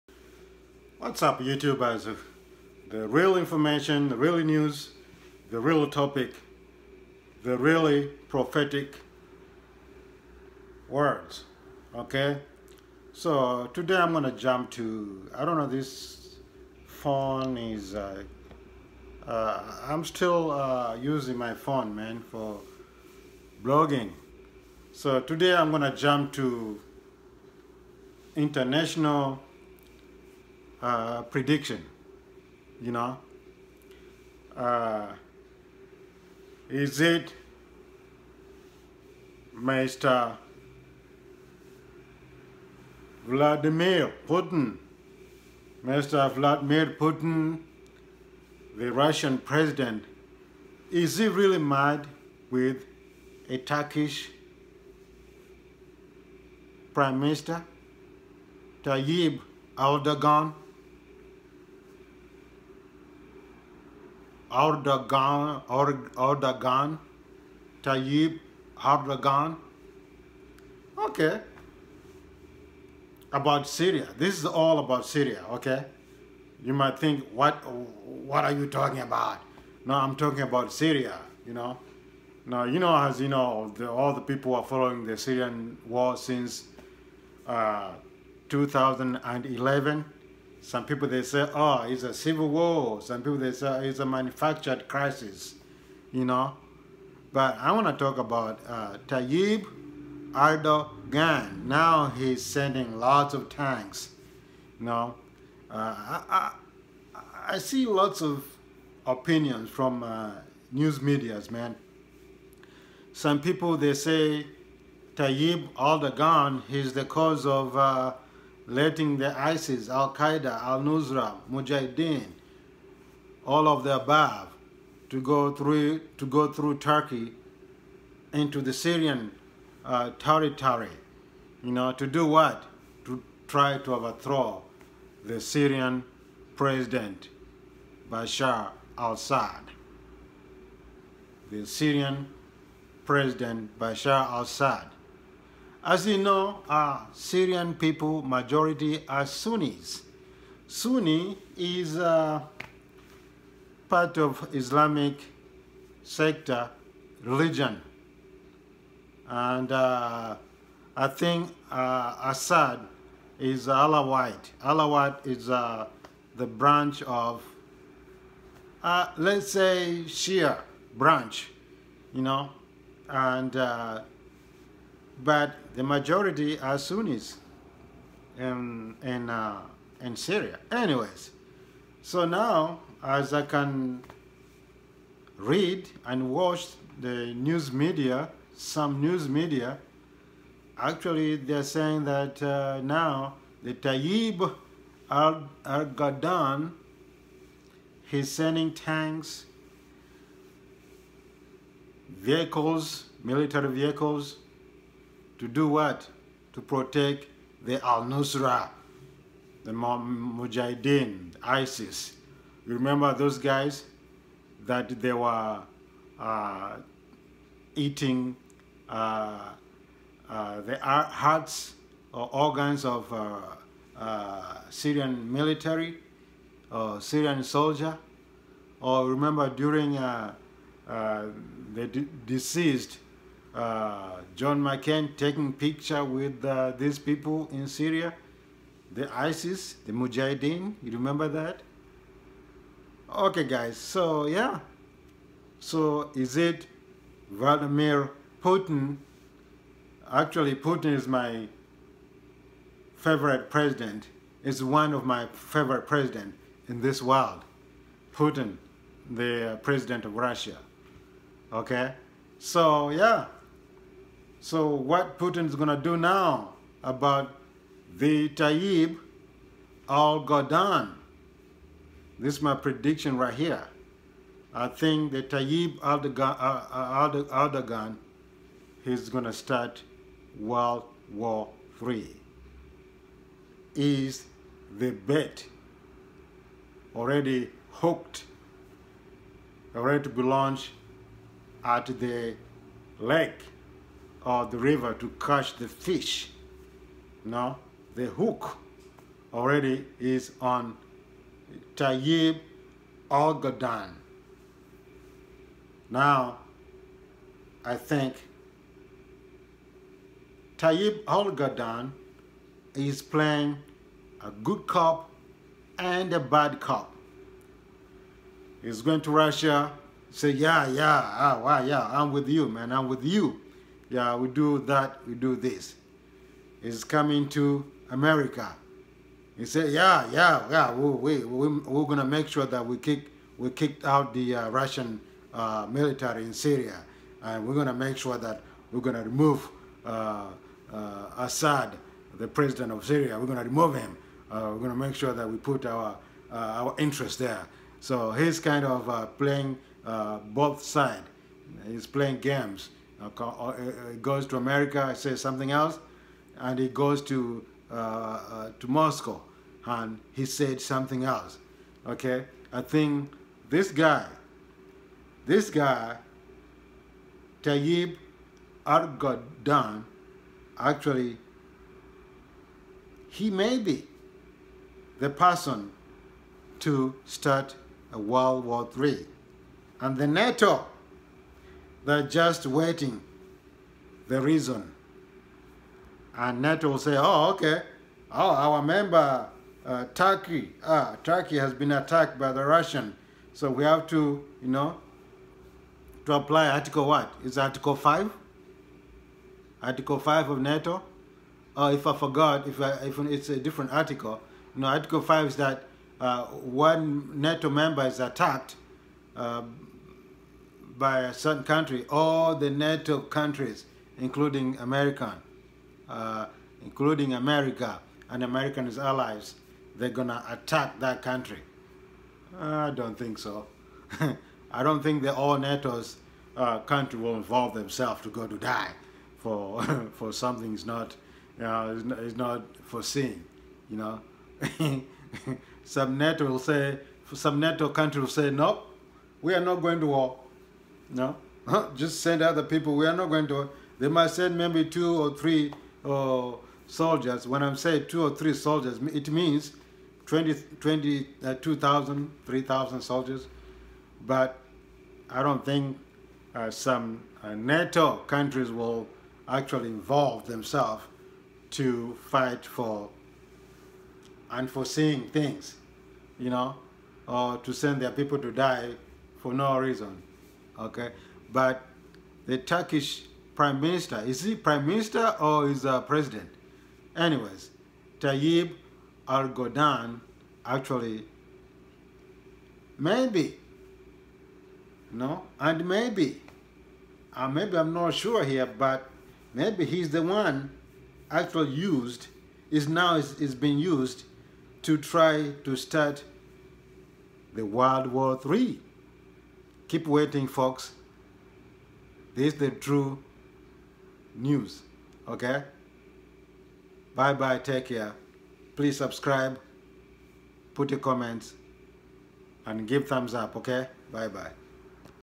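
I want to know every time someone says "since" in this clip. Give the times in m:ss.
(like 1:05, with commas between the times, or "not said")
1:26.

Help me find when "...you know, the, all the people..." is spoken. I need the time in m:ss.
1:23.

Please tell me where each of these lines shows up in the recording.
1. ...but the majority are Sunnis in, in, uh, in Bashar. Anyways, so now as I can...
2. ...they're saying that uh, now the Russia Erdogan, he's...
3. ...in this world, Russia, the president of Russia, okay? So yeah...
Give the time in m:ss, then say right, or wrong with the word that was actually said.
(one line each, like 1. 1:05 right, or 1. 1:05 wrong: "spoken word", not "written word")
1. 2:55 wrong: "Syria", not "Bashar"
2. 3:11 wrong: "Tayyip", not "Russia"
3. 4:16 wrong: "Putin", not "Russia".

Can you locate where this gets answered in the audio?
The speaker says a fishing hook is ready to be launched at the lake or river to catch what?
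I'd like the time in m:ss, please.
4:55.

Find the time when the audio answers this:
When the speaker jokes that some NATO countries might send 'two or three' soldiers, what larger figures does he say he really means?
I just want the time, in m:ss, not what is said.
7:31.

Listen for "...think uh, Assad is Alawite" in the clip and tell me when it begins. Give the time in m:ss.
2:41.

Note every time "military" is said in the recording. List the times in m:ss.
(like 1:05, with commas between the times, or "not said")
3:23, 3:45, 5:35.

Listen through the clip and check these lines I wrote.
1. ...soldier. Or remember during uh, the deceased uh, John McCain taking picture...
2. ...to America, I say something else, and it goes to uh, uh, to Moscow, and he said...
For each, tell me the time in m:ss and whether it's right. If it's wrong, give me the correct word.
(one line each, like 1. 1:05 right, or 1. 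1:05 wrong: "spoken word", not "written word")
1. 3:47 right
2. 5:54 right.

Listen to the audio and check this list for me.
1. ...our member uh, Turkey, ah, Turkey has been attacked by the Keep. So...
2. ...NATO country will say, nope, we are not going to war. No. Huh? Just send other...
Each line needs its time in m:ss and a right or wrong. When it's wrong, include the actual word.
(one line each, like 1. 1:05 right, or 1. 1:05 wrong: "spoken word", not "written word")
1. 6:28 wrong: "Russian", not "Keep"
2. 7:17 right.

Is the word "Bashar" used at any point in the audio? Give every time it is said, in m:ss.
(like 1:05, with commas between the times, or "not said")
2:18, 2:23.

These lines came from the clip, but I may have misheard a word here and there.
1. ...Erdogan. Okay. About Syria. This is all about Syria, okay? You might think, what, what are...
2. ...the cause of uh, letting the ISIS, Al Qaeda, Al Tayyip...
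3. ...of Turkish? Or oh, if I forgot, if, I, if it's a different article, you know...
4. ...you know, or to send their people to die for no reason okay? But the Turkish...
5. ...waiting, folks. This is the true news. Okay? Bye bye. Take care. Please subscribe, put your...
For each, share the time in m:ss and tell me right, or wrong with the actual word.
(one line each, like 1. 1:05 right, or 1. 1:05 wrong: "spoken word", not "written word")
1. 1:08 right
2. 1:56 wrong: "Nusra", not "Tayyip"
3. 6:40 wrong: "NATO", not "Turkish"
4. 7:46 right
5. 8:19 right.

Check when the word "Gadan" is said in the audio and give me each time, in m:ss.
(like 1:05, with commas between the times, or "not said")
5:03, 5:11.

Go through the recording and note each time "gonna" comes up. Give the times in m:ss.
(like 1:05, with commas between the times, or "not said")
0:14, 0:25, 6:59.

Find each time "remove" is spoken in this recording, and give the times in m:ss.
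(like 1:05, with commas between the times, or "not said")
5:39, 5:43.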